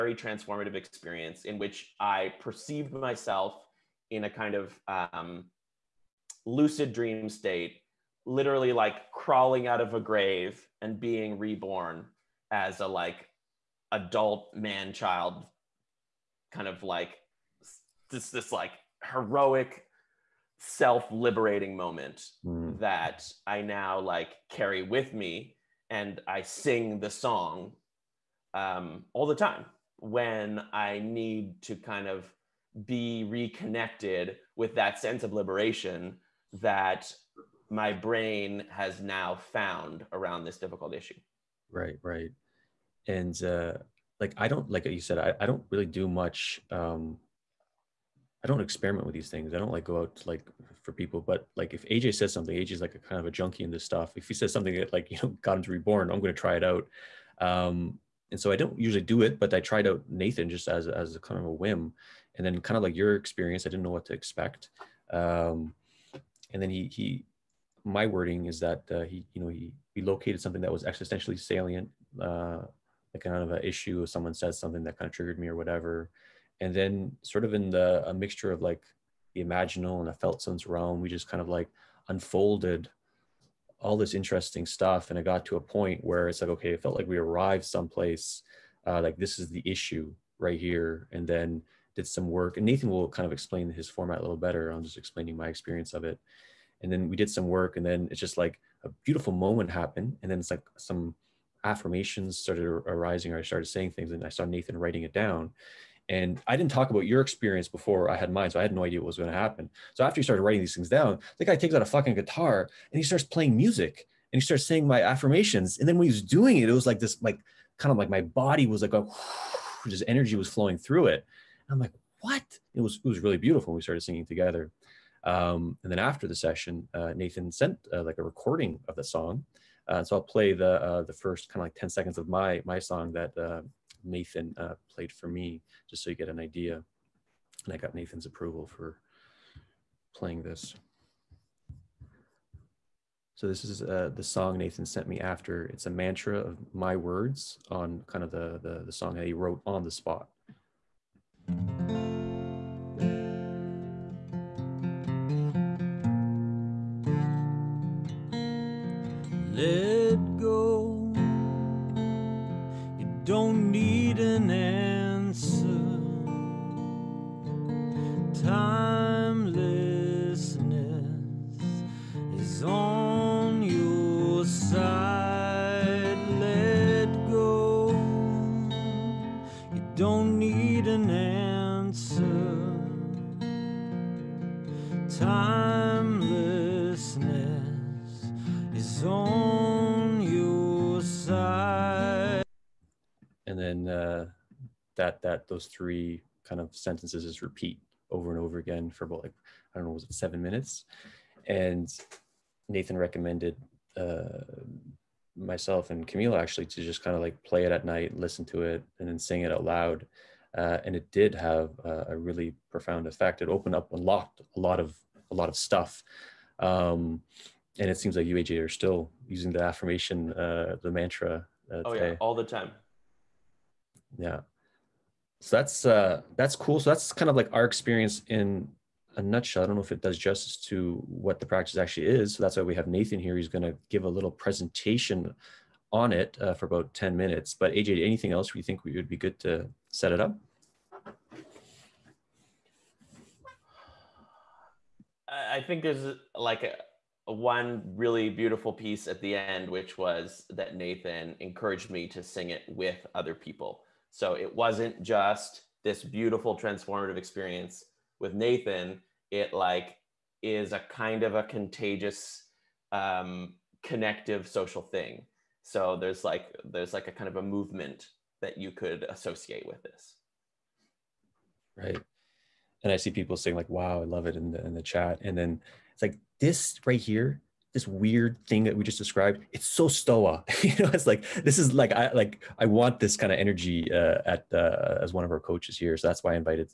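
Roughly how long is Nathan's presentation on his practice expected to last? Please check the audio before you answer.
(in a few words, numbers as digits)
10 minutes.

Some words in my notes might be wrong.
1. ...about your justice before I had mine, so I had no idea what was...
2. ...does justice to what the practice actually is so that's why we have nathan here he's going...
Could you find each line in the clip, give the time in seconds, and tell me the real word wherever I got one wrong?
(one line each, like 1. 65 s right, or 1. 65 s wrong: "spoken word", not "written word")
1. 106 s wrong: "experience", not "justice"
2. 230 s right.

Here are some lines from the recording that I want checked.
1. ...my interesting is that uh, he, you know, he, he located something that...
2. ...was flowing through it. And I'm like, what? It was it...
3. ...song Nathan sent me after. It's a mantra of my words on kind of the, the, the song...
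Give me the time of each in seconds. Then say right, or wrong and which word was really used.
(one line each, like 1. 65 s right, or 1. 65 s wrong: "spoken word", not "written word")
1. 67 s wrong: "wording", not "interesting"
2. 120 s right
3. 144 s right.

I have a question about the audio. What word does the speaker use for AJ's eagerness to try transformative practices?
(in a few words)
Junkie.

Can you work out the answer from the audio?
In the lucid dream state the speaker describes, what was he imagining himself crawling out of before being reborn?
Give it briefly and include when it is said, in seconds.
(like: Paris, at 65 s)
A grave, at 9 s.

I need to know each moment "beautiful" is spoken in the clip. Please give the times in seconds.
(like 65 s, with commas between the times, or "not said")
99 s, 123 s, 248 s, 256 s.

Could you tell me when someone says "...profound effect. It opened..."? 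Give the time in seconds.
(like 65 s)
212 s.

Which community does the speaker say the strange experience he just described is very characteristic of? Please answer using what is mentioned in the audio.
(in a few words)
Stoa.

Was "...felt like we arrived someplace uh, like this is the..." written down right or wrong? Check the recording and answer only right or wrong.
right.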